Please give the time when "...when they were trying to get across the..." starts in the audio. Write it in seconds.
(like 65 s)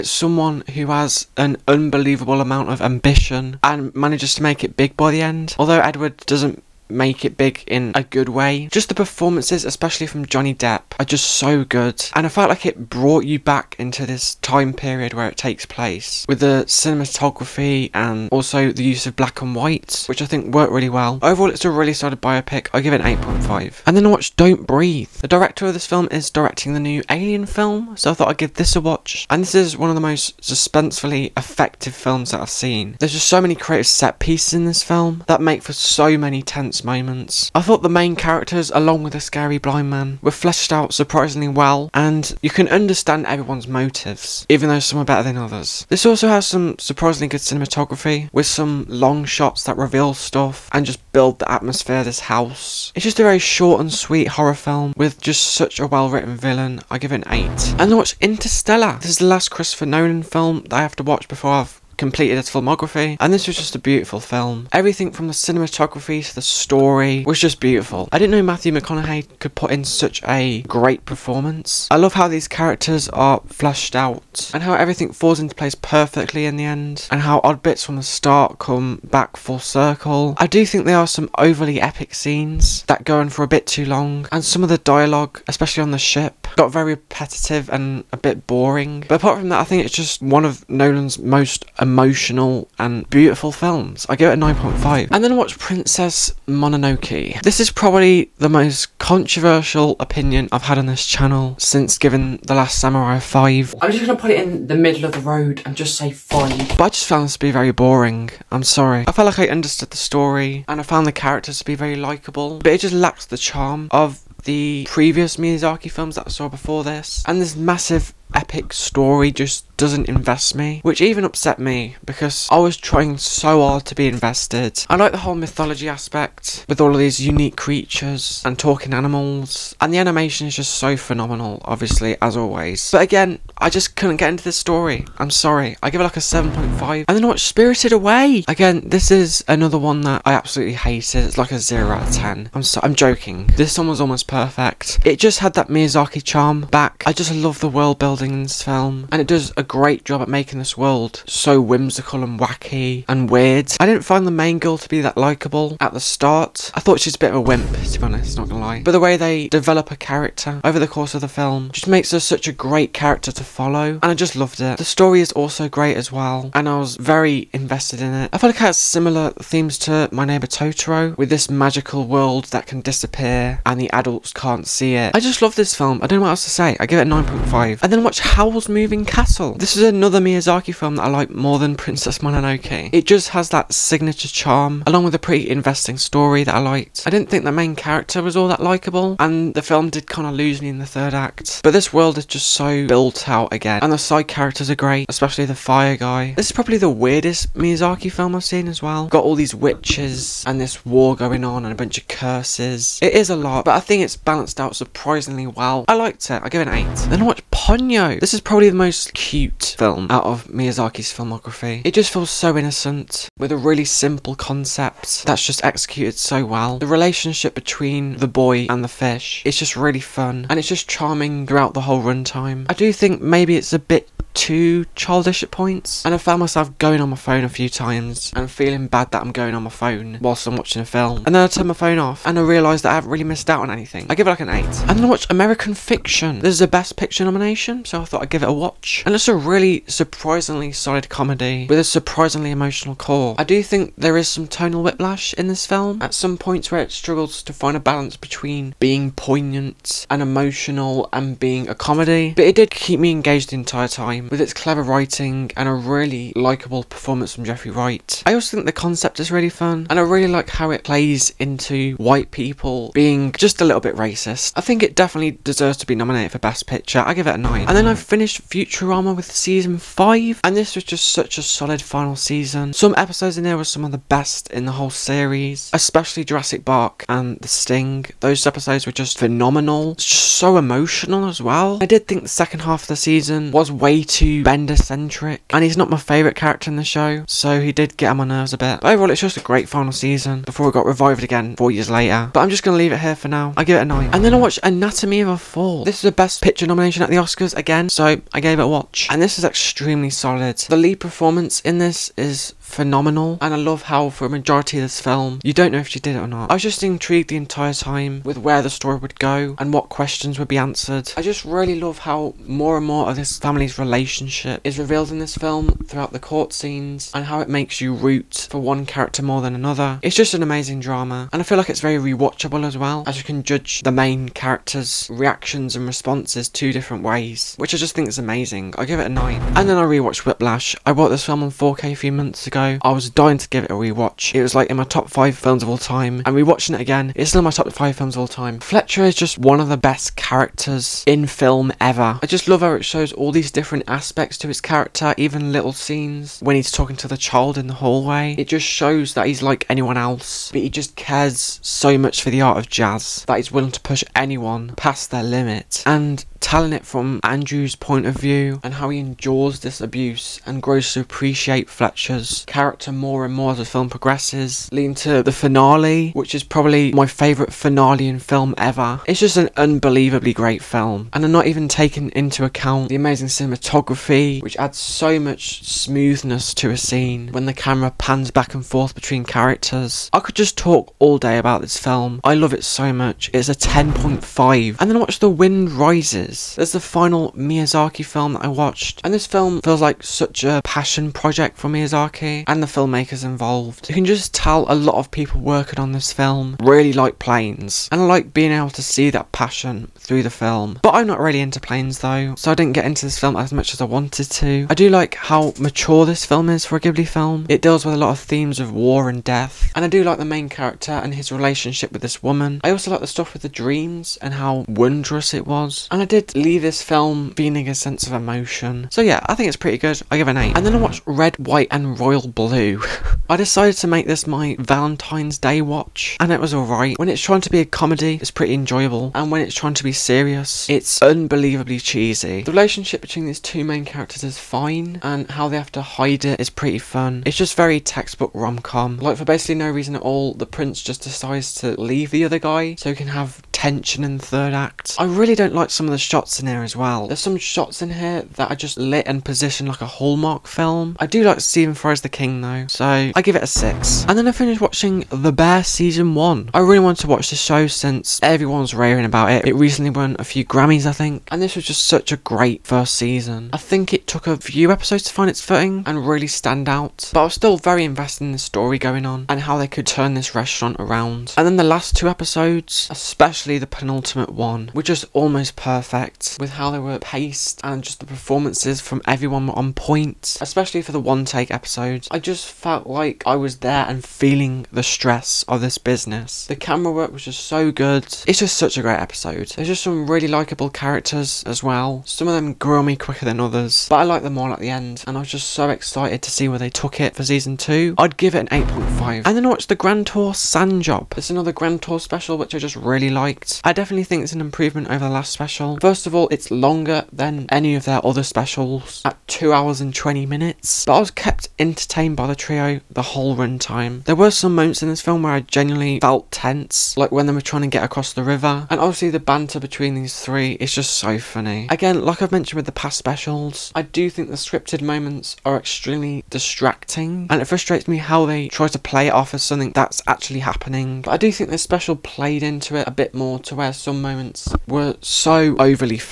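517 s.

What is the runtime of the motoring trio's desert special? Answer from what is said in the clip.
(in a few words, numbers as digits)
2 hours 20 minutes.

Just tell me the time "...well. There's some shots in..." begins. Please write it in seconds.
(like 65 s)
446 s.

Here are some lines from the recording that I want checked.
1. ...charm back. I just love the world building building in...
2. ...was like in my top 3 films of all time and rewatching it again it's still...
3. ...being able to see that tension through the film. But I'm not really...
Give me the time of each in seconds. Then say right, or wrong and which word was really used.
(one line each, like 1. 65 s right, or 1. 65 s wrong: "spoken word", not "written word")
1. 146 s right
2. 334 s wrong: "5", not "3"
3. 398 s wrong: "passion", not "tension".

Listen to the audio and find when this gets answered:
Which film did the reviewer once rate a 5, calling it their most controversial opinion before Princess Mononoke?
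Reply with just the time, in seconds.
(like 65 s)
102 s.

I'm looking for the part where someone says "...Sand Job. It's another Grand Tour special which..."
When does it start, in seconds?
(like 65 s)
500 s.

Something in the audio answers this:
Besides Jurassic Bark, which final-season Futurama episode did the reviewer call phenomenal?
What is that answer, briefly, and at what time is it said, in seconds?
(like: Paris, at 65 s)
The Sting, at 277 s.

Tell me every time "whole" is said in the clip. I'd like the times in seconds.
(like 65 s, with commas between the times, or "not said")
125 s, 221 s, 274 s, 513 s.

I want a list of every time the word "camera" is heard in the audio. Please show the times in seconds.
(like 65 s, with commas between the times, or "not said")
377 s, 486 s.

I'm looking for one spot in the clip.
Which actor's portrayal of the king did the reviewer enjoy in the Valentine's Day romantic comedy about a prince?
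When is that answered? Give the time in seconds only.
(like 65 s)
451 s.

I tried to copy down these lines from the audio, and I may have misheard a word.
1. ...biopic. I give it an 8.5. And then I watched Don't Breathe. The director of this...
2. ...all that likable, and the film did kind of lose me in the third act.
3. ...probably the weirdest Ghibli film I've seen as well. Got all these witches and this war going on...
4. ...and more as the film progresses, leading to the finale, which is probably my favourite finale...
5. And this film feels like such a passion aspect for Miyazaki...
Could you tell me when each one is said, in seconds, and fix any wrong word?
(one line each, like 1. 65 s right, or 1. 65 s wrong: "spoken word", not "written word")
1. 22 s right
2. 188 s right
3. 196 s wrong: "Miyazaki", not "Ghibli"
4. 363 s right
5. 389 s wrong: "project", not "aspect".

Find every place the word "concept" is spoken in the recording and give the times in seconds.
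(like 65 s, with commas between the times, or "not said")
214 s, 258 s.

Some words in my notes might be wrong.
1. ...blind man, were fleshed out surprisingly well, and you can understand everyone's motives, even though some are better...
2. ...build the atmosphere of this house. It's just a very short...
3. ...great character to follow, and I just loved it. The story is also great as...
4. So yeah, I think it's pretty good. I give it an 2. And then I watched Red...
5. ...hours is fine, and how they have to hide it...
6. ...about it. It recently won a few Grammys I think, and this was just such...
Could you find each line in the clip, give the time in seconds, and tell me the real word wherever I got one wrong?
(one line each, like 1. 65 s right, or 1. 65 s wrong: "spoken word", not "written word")
1. 39 s right
2. 51 s right
3. 162 s right
4. 418 s wrong: "8", not "2"
5. 433 s wrong: "characters", not "hours"
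6. 459 s right.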